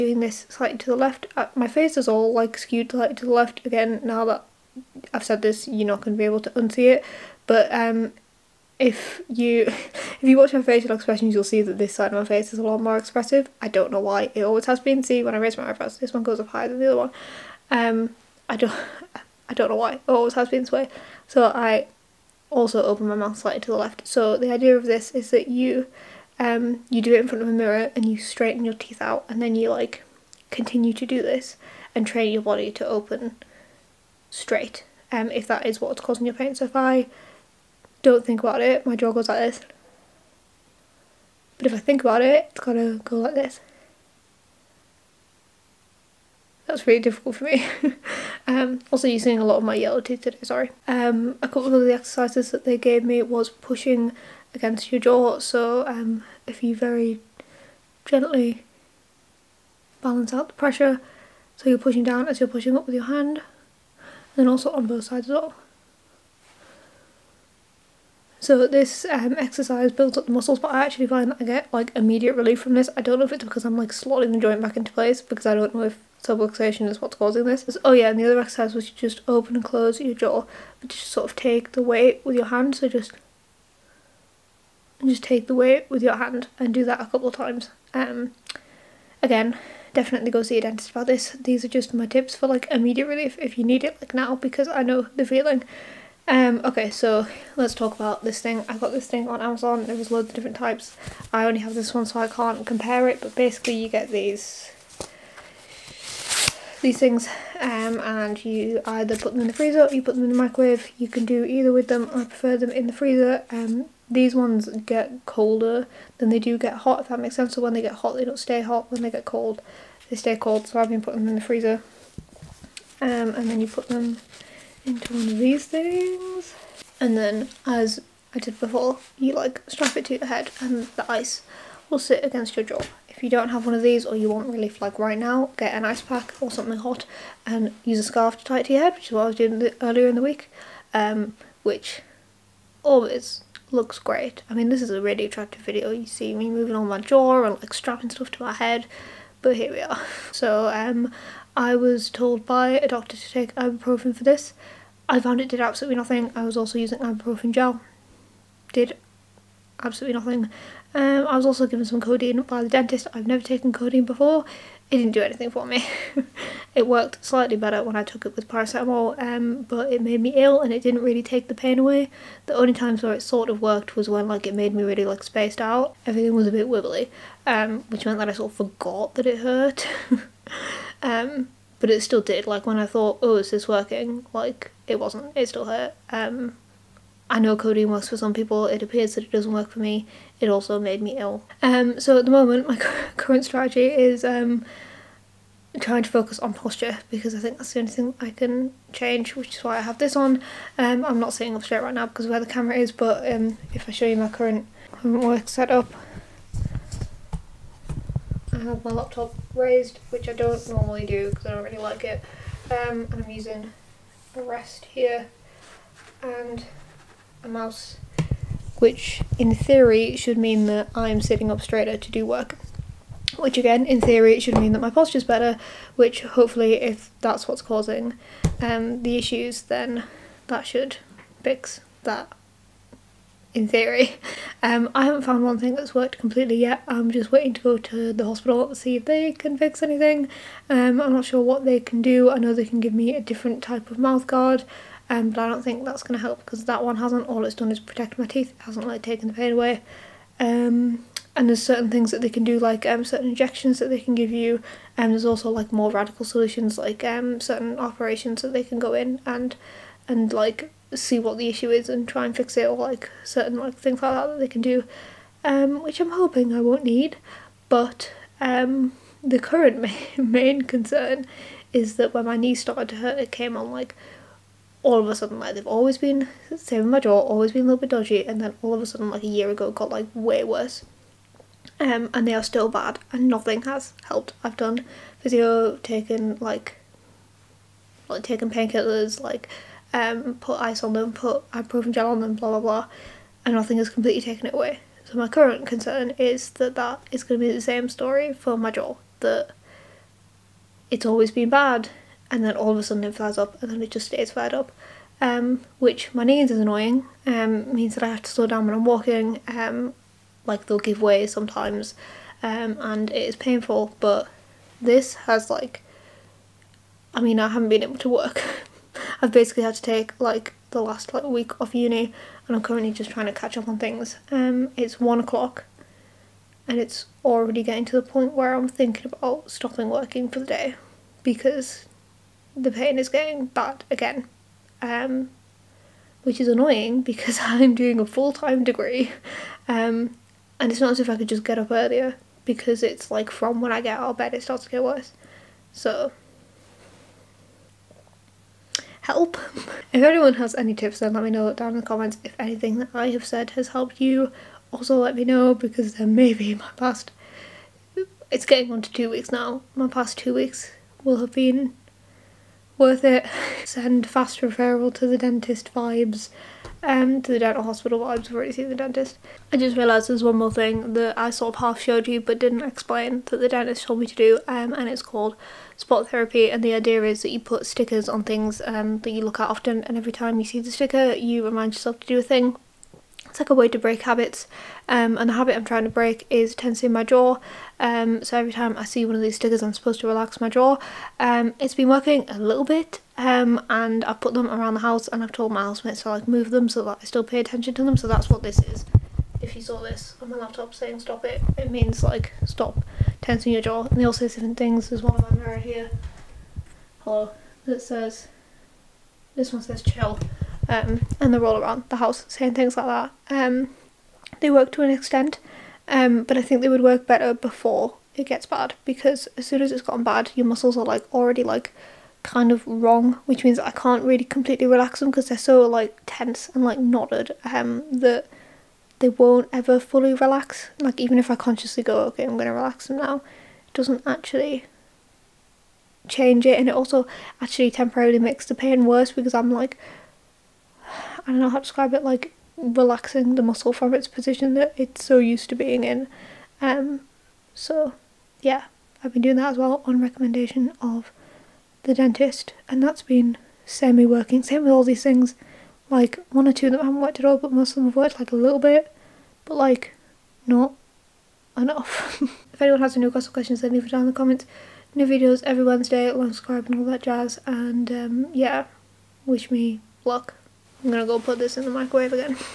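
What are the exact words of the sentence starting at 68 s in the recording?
So this um, exercise builds up the muscles but I actually find that I get like immediate relief from this.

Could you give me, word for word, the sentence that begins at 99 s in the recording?
There was loads of different types.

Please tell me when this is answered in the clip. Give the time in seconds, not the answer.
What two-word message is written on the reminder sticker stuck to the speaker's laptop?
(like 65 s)
400 s.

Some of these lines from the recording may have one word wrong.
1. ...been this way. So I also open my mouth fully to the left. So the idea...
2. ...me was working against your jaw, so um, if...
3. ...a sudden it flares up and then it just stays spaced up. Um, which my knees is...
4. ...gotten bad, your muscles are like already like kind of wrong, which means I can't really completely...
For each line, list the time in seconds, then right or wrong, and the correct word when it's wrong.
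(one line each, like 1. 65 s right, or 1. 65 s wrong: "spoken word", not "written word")
1. 20 s wrong: "slightly", not "fully"
2. 53 s wrong: "pushing", not "working"
3. 302 s wrong: "flared", not "spaced"
4. 419 s right.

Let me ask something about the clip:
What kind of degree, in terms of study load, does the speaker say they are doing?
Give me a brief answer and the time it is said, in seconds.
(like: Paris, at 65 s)
Full time, at 338 s.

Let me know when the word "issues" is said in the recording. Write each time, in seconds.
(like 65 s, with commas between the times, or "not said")
229 s, 261 s.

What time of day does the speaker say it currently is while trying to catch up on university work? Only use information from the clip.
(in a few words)
1 o'clock.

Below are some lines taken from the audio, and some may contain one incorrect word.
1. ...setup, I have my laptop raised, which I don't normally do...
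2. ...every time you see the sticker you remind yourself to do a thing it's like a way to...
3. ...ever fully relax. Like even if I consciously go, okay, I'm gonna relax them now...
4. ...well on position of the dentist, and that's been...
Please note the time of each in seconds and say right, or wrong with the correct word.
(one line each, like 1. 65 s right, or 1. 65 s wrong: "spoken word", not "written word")
1. 205 s right
2. 379 s right
3. 429 s right
4. 449 s wrong: "recommendation", not "position".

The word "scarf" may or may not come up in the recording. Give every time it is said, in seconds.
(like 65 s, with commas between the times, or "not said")
138 s.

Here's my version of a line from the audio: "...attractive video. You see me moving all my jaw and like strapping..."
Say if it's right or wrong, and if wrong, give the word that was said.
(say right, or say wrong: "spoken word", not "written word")
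right.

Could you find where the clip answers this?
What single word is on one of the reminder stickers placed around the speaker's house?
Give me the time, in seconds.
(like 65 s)
409 s.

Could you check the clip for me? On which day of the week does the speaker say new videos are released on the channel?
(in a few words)
Wednesday.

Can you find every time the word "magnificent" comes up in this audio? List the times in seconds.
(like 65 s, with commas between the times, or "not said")
not said.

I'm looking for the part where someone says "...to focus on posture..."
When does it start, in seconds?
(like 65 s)
196 s.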